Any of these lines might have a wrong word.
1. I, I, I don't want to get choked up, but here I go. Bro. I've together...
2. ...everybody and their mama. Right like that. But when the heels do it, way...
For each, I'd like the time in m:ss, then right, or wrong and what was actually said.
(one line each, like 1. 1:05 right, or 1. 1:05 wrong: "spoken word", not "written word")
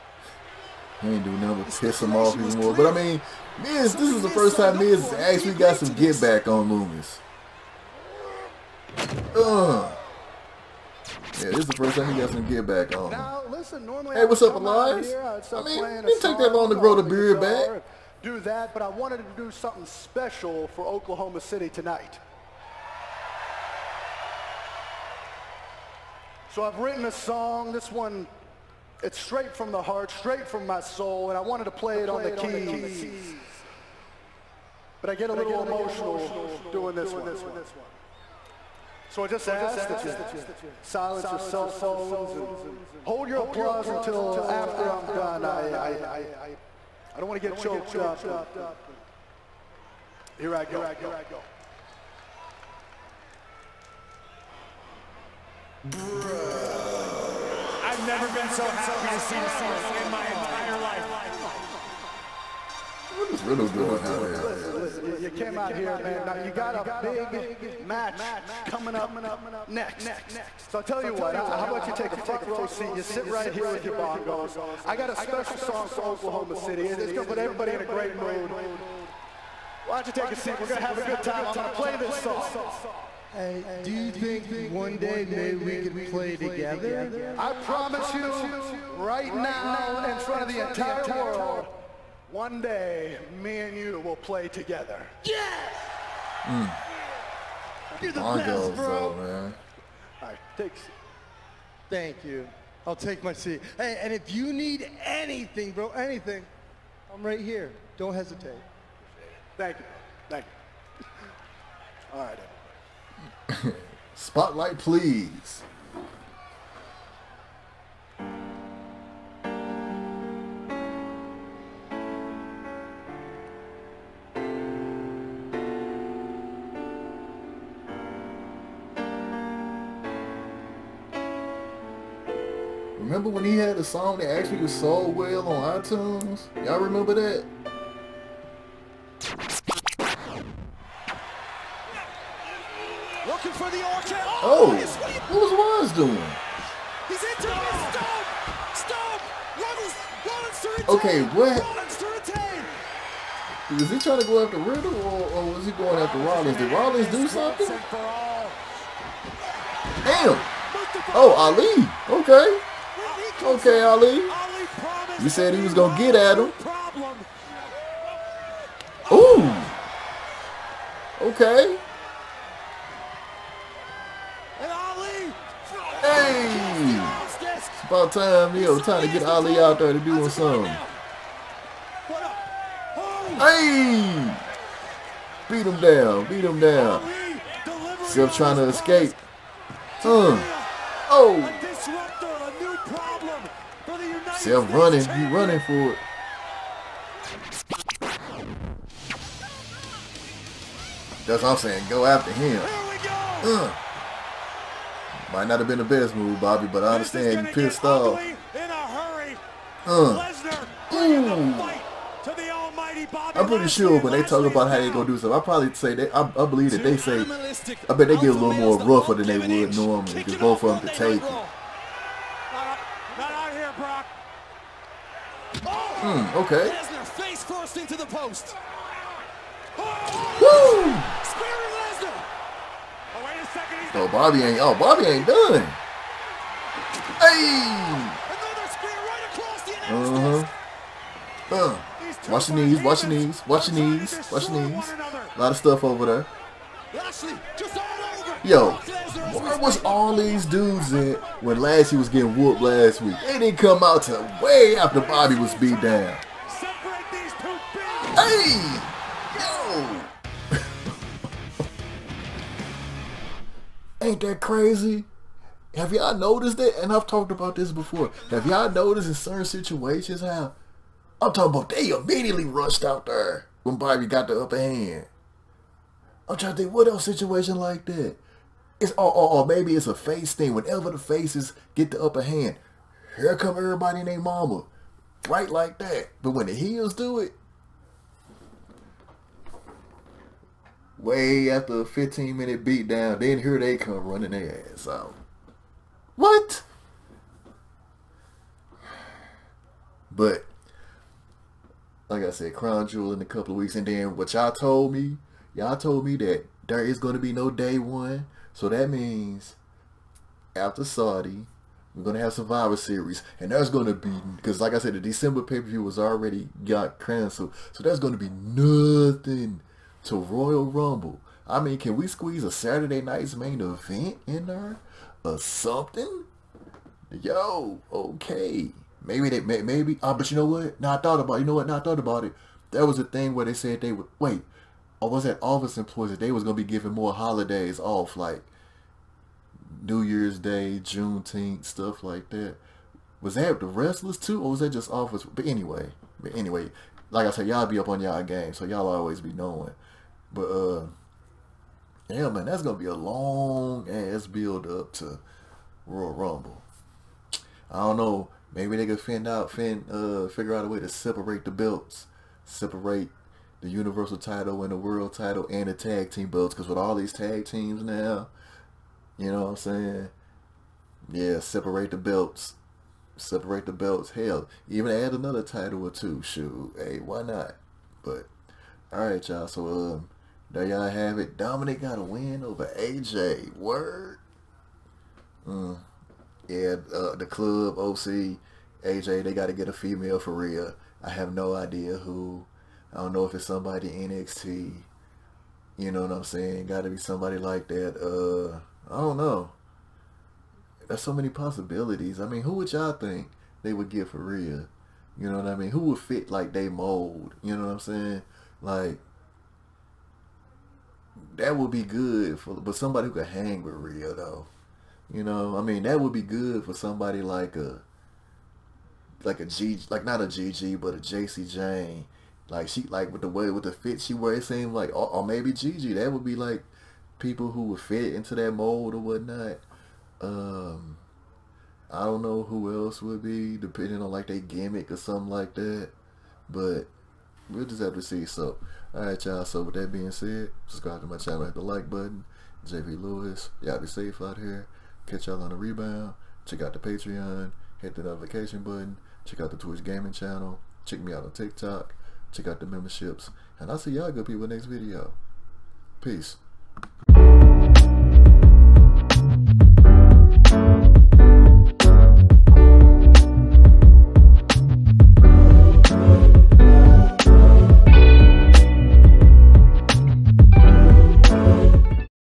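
1. 0:45 wrong: "never", not "together"
2. 4:43 right.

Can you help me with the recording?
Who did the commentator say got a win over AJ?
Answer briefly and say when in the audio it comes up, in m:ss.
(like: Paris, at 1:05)
Dominic, at 6:21.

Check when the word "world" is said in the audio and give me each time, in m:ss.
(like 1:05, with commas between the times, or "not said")
1:31, 6:04.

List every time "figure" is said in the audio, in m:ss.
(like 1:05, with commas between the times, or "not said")
6:00.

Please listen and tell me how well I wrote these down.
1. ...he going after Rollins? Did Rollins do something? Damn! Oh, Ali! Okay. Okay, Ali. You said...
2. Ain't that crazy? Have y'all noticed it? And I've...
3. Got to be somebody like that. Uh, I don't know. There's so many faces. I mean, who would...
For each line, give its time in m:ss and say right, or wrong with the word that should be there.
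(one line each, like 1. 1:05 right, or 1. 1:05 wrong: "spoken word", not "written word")
1. 2:35 right
2. 4:24 right
3. 6:36 wrong: "possibilities", not "faces".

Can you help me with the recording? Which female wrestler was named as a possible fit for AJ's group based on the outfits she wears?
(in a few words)
Jacy Jayne.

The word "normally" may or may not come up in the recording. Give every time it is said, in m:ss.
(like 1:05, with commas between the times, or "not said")
0:13, 3:39.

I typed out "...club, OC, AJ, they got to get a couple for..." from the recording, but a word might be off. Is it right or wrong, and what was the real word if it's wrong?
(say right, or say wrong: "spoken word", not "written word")
wrong: "female", not "couple".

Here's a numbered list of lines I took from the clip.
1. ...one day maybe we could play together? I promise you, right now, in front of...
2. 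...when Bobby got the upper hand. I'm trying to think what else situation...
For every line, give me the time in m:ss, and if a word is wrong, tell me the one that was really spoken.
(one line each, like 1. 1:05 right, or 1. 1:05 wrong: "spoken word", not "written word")
1. 1:24 right
2. 4:33 right.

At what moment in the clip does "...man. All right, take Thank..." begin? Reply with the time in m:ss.
1:39.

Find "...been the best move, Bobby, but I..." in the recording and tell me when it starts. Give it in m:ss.
3:25.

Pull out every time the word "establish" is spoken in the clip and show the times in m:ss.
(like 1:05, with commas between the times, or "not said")
not said.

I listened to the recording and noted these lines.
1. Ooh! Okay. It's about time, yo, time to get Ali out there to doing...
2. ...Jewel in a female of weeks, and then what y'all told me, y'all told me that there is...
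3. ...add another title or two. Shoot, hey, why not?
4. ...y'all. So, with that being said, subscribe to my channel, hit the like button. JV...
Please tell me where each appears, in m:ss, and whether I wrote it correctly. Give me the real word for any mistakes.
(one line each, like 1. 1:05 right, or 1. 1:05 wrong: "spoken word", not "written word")
1. 2:49 right
2. 5:02 wrong: "couple", not "female"
3. 6:14 right
4. 7:19 right.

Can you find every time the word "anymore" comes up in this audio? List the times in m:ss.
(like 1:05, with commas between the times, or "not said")
0:02.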